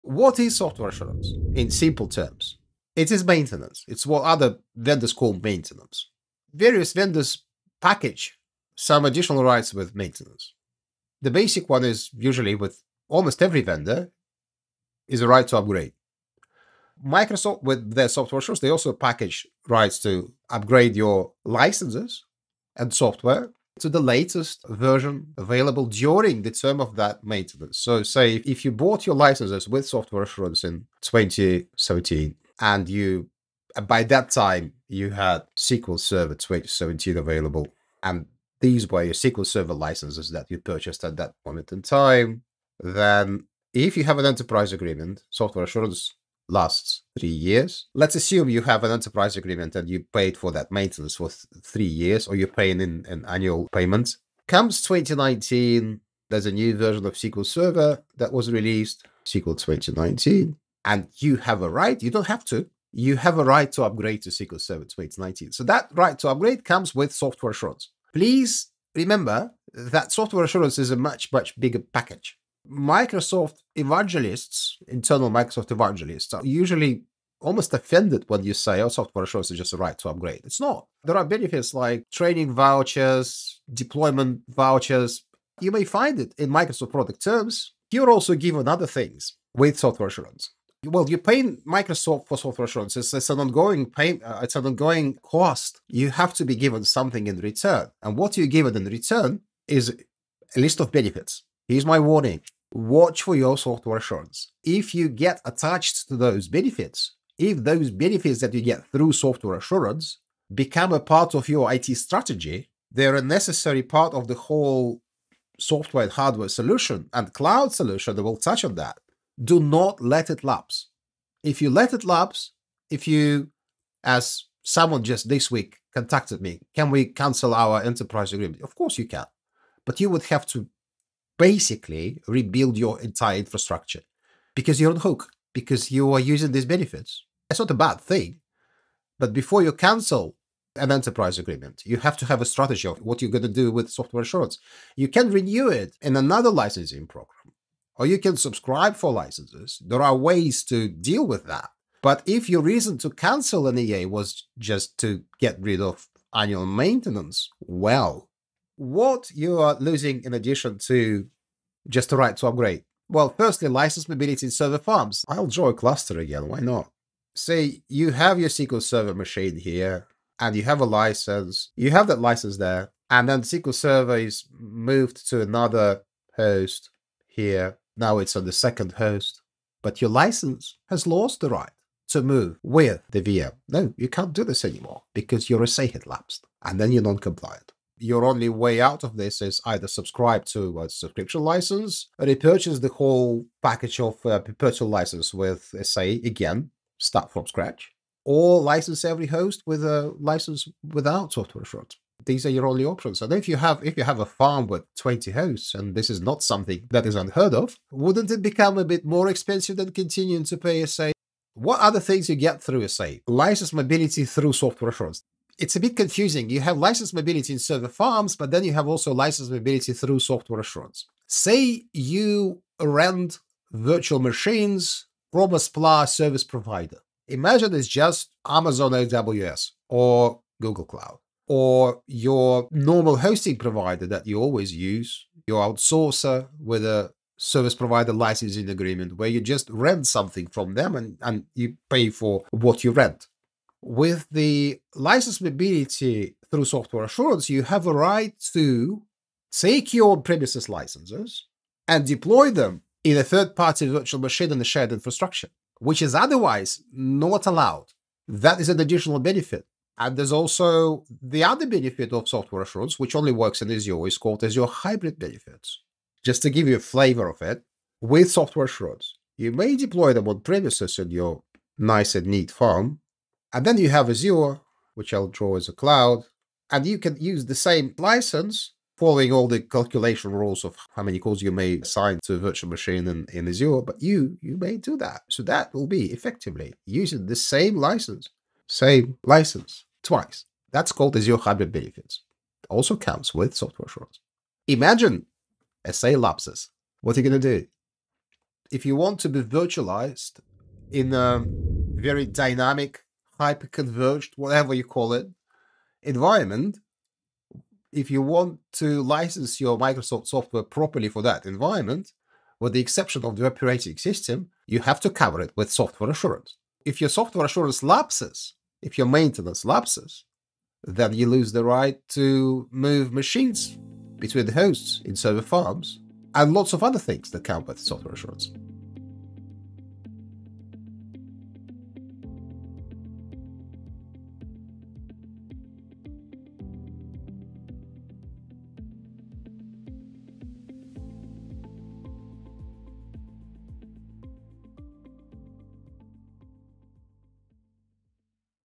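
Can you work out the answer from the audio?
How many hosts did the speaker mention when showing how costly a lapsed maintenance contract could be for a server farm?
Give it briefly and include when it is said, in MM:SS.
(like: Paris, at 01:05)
20, at 03:24.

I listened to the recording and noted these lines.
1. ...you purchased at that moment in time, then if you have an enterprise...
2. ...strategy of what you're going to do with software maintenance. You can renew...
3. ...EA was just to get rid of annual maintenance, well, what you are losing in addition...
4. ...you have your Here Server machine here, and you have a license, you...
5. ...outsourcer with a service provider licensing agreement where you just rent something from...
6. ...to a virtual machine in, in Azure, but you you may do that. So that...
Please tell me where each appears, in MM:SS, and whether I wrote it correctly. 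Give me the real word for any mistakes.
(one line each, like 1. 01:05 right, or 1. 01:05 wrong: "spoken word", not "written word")
1. 00:40 right
2. 02:22 wrong: "assurance", not "maintenance"
3. 02:33 right
4. 02:47 wrong: "SQL", not "Here"
5. 03:55 right
6. 04:42 right.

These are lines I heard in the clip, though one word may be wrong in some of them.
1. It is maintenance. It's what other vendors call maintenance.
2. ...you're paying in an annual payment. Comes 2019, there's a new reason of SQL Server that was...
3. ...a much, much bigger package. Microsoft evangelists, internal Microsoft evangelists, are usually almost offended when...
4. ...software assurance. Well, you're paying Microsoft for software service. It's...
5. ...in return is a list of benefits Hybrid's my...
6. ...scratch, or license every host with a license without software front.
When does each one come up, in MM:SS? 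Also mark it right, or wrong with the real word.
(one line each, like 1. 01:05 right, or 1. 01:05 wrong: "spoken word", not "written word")
1. 00:02 right
2. 00:52 wrong: "version", not "reason"
3. 01:10 right
4. 01:29 wrong: "assurance", not "service"
5. 01:38 wrong: "Here", not "Hybrid"
6. 03:17 right.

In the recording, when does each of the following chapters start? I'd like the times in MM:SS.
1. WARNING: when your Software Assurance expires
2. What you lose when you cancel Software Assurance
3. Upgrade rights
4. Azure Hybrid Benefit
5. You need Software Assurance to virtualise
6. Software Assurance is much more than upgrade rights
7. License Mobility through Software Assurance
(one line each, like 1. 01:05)
1. 01:41
2. 02:40
3. 00:30
4. 04:20
5. 05:00
6. 01:08
7. 03:30.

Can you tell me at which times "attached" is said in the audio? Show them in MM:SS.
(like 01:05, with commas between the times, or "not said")
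01:45.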